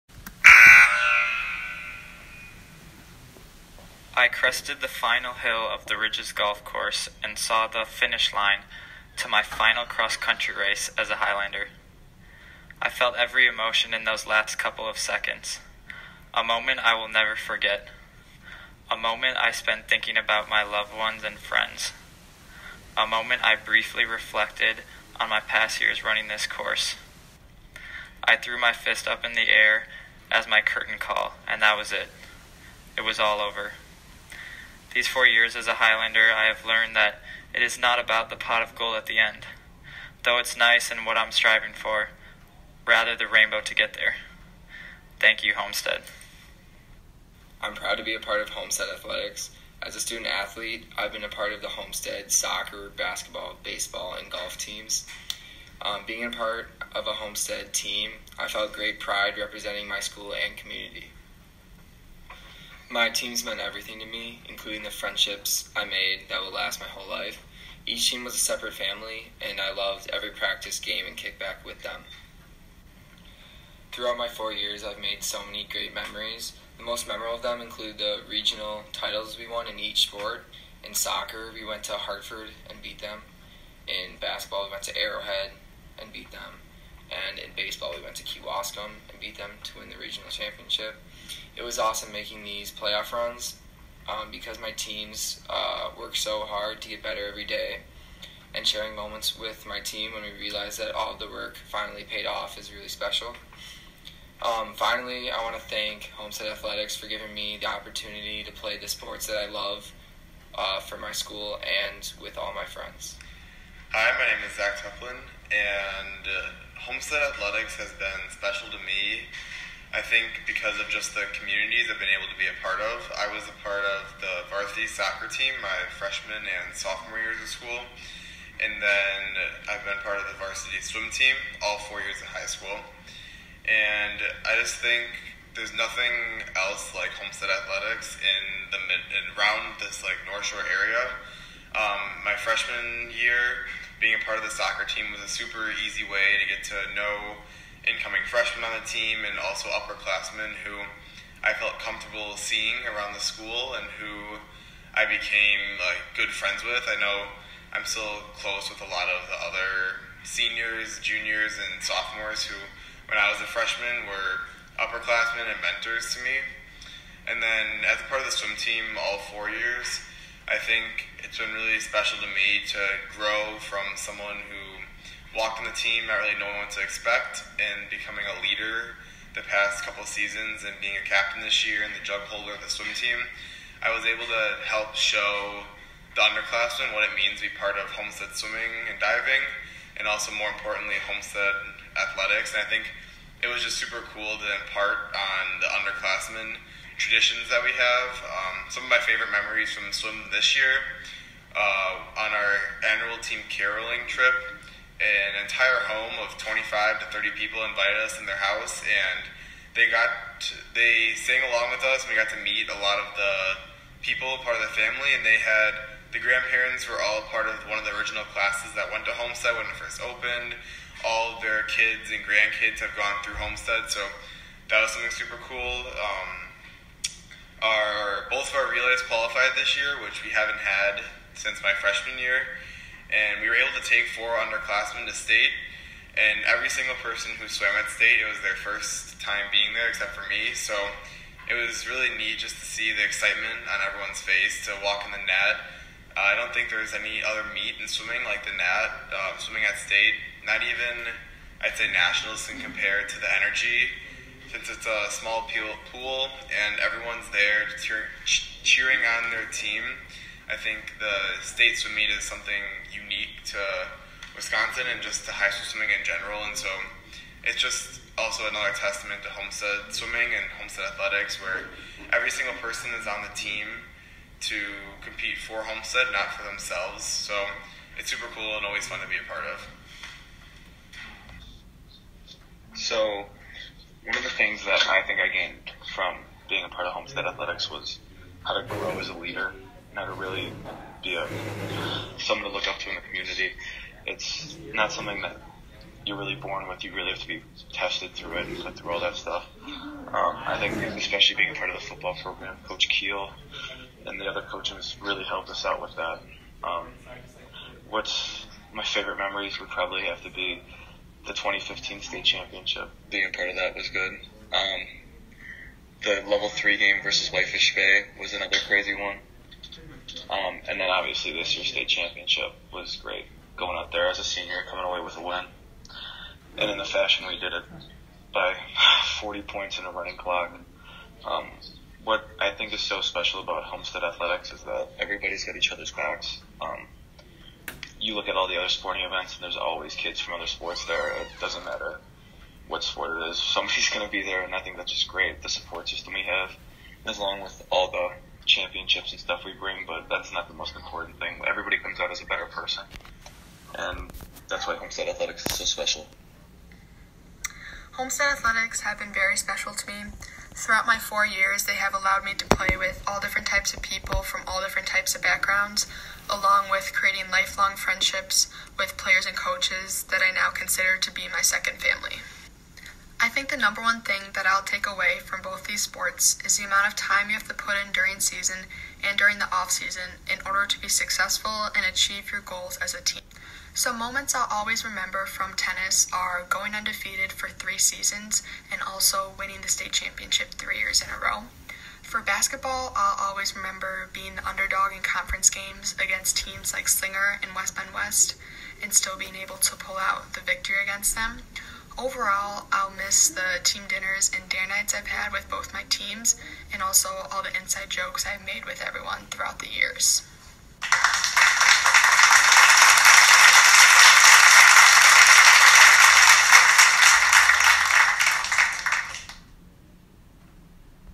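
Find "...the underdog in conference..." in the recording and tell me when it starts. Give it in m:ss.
6:34.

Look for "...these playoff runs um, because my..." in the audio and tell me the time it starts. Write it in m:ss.
1:32.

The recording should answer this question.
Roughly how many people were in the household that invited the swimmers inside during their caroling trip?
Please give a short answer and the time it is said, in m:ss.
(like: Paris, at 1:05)
25 to 30, at 3:26.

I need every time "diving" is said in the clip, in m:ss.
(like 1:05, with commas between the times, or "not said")
3:08.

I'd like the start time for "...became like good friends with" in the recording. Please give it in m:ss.
2:35.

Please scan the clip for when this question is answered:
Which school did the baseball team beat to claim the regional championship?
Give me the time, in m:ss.
1:28.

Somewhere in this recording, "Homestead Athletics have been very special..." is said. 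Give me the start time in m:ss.
5:57.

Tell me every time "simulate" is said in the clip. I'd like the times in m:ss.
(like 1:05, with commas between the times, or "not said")
not said.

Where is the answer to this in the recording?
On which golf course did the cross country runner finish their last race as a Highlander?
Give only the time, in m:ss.
0:05.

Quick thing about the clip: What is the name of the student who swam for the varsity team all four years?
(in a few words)
Zach Teplin.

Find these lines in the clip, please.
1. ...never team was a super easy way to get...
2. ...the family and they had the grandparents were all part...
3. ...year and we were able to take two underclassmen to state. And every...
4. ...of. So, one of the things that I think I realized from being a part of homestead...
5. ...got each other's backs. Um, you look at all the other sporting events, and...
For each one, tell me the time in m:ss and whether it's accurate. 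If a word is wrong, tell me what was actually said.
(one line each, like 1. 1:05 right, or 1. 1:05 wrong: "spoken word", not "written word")
1. 2:24 wrong: "soccer", not "never"
2. 3:34 right
3. 3:52 wrong: "four", not "two"
4. 4:39 wrong: "gained", not "realized"
5. 5:35 right.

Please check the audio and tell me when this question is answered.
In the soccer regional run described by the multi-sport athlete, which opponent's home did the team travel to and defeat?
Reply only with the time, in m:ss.
1:21.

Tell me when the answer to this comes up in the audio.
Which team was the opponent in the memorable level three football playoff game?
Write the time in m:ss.
5:17.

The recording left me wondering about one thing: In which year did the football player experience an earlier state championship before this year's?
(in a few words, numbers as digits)
2015.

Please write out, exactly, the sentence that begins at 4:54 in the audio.
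It's not something that you're really born with.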